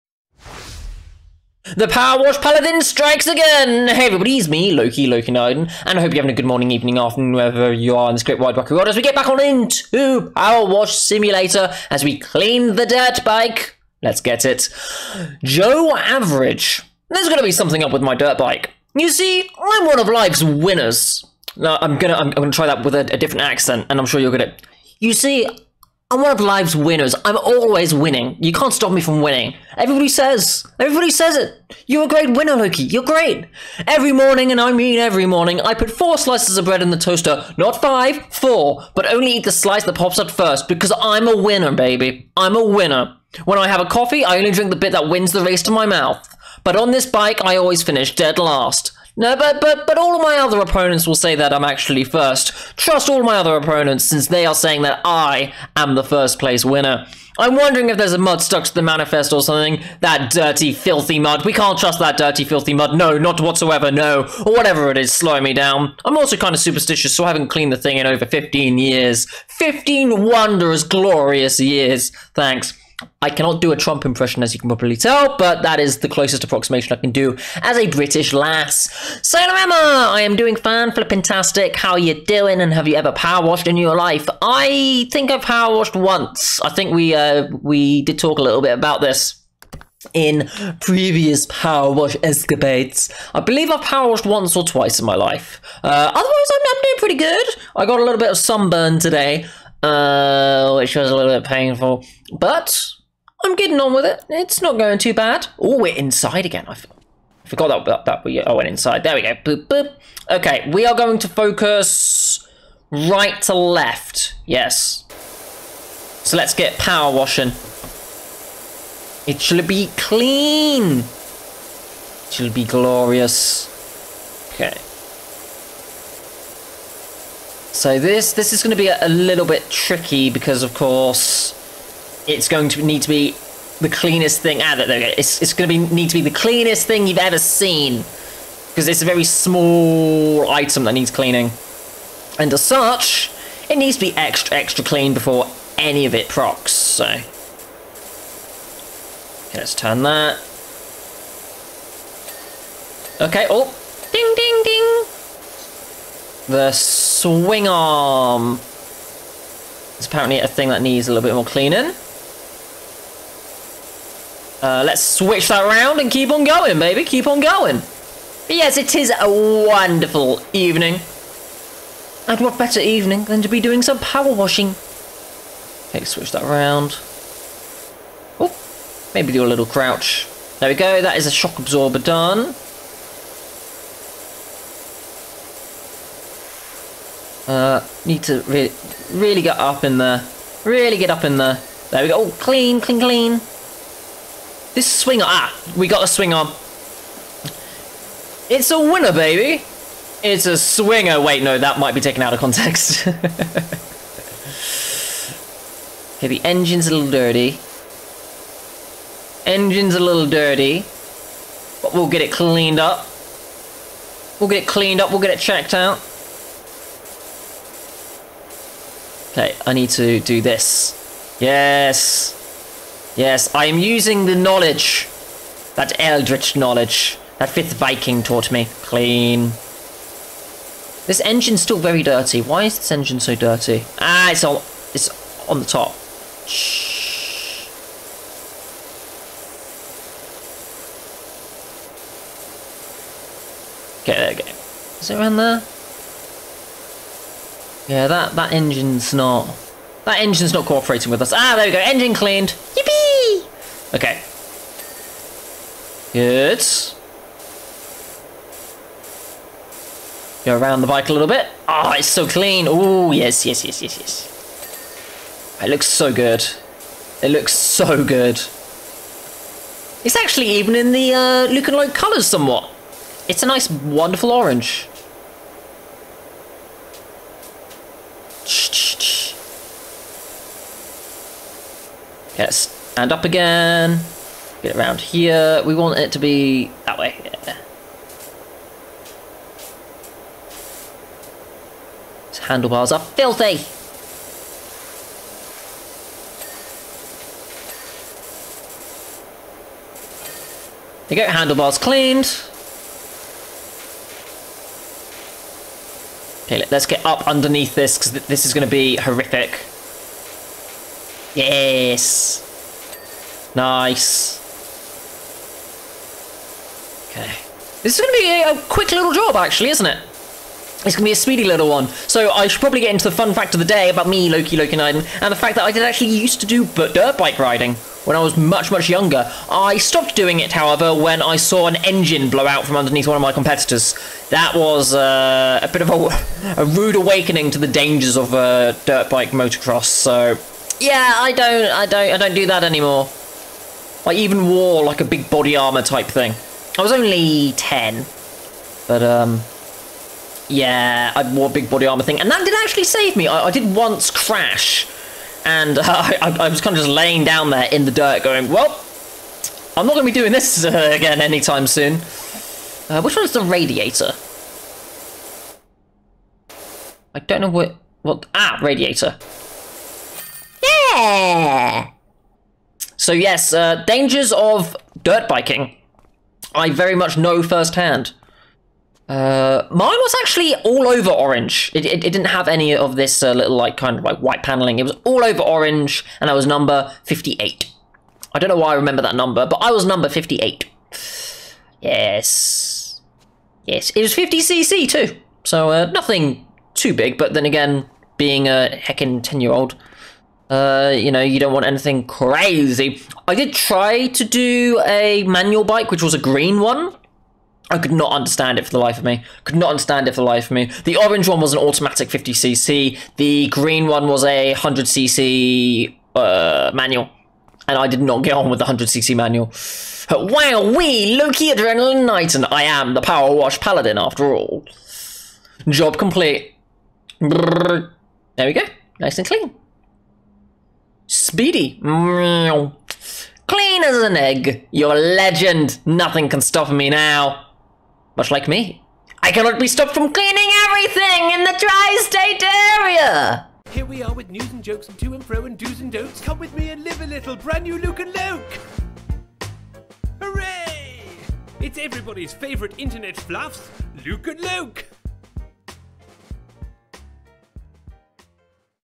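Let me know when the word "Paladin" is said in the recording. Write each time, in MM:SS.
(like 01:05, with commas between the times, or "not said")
00:02, 07:03.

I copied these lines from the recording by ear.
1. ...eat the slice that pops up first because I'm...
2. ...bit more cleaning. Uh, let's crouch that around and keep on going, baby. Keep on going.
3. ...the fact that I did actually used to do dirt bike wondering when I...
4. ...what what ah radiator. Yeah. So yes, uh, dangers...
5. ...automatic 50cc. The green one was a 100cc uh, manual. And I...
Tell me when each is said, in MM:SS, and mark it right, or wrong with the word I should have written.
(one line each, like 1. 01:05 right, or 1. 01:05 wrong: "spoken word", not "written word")
1. 00:39 right
2. 02:41 wrong: "switch", not "crouch"
3. 05:25 wrong: "riding", not "wondering"
4. 06:07 right
5. 06:51 right.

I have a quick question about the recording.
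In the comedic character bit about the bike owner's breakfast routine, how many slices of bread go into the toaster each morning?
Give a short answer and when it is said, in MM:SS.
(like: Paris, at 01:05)
4, at 00:35.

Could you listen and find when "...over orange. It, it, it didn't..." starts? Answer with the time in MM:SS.
06:20.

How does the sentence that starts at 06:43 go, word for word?
I did try to do a manual bike, which was a green one.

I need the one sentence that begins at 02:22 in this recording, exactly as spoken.
And as such, it needs to be extra, extra clean before any of it procs, so.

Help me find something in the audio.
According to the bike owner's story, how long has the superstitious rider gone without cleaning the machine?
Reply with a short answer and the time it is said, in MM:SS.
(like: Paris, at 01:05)
15 years, at 01:08.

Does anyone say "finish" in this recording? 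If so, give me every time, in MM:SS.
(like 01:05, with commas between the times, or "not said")
00:47.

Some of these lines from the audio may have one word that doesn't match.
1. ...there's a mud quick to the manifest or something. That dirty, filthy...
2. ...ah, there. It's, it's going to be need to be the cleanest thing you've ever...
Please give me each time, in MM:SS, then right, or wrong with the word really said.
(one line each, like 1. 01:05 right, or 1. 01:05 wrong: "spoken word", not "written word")
1. 00:57 wrong: "stuck", not "quick"
2. 02:14 right.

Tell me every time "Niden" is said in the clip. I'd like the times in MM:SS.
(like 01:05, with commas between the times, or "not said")
00:05.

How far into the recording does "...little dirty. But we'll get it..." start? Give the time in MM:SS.
03:29.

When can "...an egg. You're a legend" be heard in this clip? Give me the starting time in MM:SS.
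07:13.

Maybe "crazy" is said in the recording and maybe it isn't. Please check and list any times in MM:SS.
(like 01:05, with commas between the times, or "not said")
06:42.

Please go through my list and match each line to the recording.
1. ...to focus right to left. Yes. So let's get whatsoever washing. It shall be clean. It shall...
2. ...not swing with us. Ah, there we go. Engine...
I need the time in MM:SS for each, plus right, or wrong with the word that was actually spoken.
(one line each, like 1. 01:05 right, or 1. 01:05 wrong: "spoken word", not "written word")
1. 01:51 wrong: "power", not "whatsoever"
2. 04:10 wrong: "cooperating", not "swing".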